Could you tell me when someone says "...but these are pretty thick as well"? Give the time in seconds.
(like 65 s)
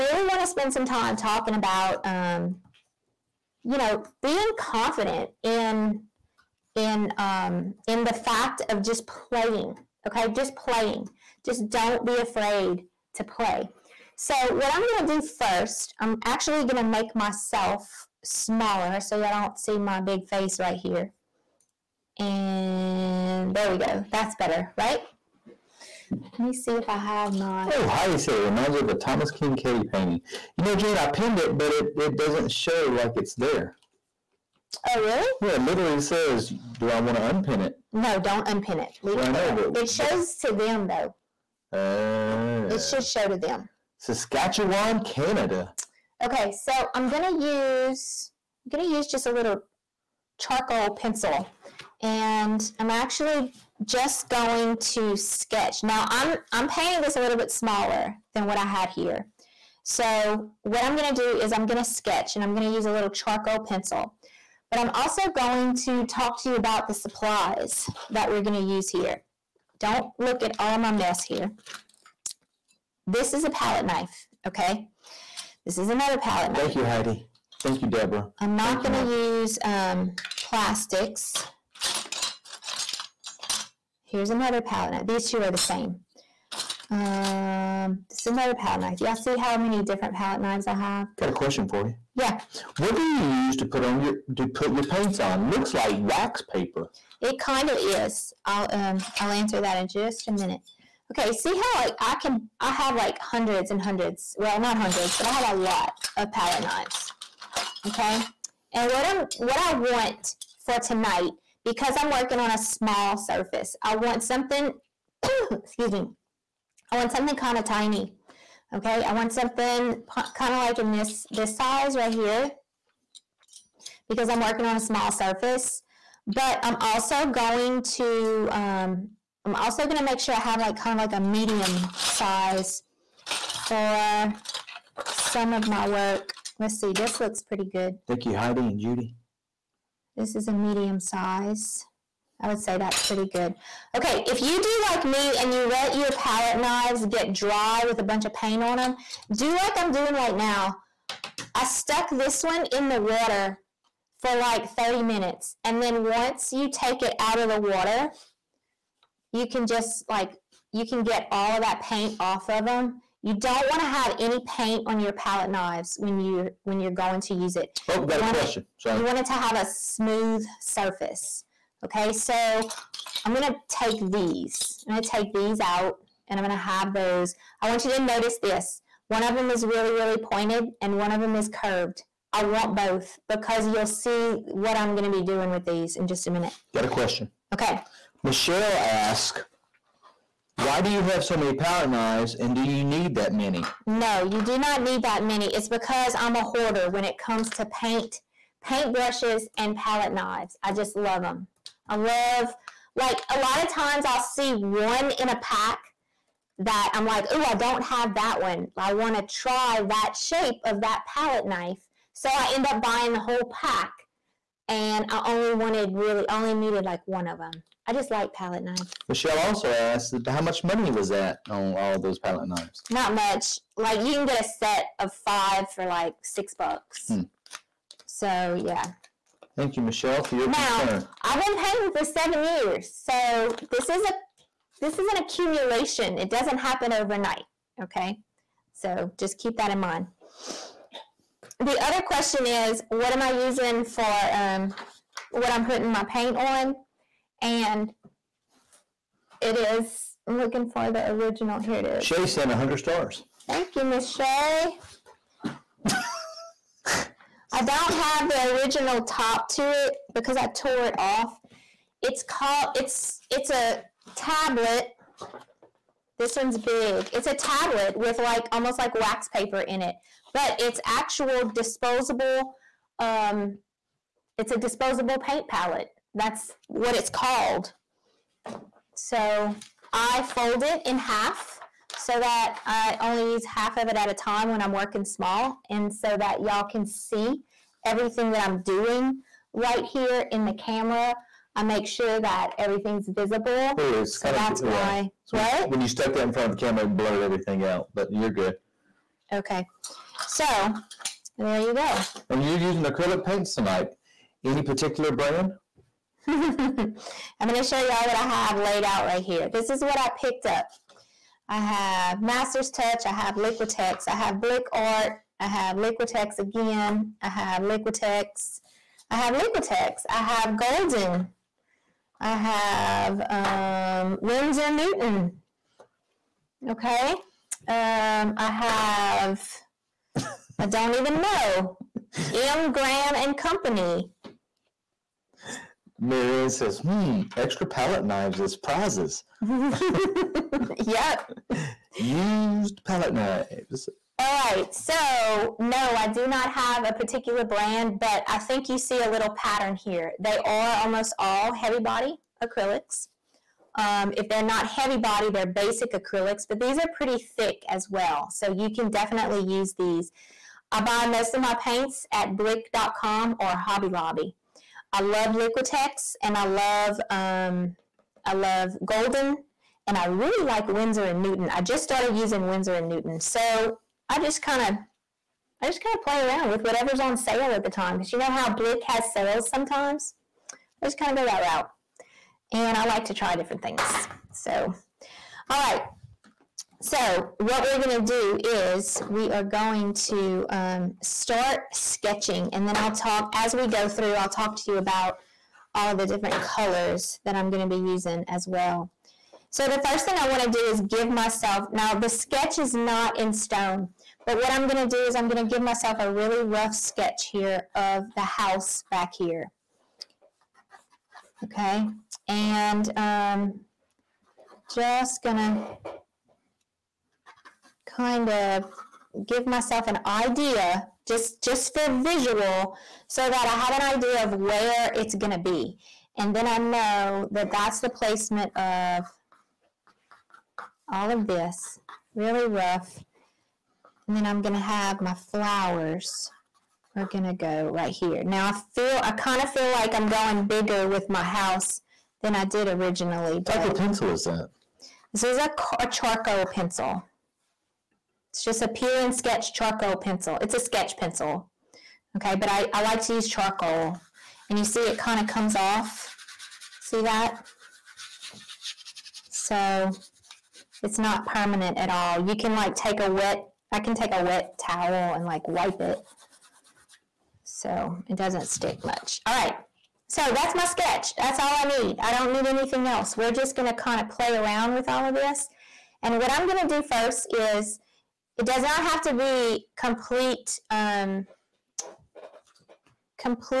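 356 s.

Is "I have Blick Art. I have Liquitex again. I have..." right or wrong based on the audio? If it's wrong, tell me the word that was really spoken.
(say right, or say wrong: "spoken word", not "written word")
right.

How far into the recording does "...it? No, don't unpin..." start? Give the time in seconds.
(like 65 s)
37 s.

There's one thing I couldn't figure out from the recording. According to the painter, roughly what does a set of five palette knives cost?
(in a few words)
$6.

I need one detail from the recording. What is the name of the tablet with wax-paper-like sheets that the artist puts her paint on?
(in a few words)
disposable paint palette.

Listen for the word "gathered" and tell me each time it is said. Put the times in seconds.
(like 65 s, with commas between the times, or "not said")
not said.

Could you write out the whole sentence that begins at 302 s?
And you're using acrylic paints tonight.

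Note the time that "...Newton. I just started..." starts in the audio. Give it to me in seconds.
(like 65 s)
371 s.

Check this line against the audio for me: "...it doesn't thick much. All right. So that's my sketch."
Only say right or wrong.
wrong.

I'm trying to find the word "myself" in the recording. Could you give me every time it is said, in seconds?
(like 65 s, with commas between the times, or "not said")
17 s, 401 s, 405 s, 419 s.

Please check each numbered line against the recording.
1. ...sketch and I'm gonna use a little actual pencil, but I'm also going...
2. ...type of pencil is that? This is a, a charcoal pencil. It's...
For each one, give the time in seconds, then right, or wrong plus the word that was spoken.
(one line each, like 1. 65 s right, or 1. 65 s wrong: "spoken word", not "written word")
1. 61 s wrong: "charcoal", not "actual"
2. 443 s right.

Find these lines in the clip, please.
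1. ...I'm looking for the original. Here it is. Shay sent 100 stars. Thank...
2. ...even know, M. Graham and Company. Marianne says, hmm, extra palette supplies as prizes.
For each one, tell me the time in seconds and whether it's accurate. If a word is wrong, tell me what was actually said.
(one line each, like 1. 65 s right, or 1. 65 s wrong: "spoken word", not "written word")
1. 250 s right
2. 330 s wrong: "knives", not "supplies".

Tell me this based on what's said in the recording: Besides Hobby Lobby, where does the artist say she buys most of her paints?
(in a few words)
blick.com.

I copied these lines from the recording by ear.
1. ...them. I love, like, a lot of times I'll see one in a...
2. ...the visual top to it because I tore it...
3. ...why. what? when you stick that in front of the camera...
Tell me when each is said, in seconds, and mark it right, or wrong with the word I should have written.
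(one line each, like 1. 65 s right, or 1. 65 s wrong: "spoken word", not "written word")
1. 201 s right
2. 258 s wrong: "original", not "visual"
3. 295 s wrong: "stuck", not "stick".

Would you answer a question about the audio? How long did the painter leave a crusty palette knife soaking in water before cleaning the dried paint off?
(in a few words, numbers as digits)
30 minutes.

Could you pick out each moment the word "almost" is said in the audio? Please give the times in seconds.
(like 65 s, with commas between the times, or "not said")
268 s, 350 s.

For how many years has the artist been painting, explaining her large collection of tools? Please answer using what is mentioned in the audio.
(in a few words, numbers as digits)
7.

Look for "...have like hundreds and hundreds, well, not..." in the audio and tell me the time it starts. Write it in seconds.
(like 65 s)
102 s.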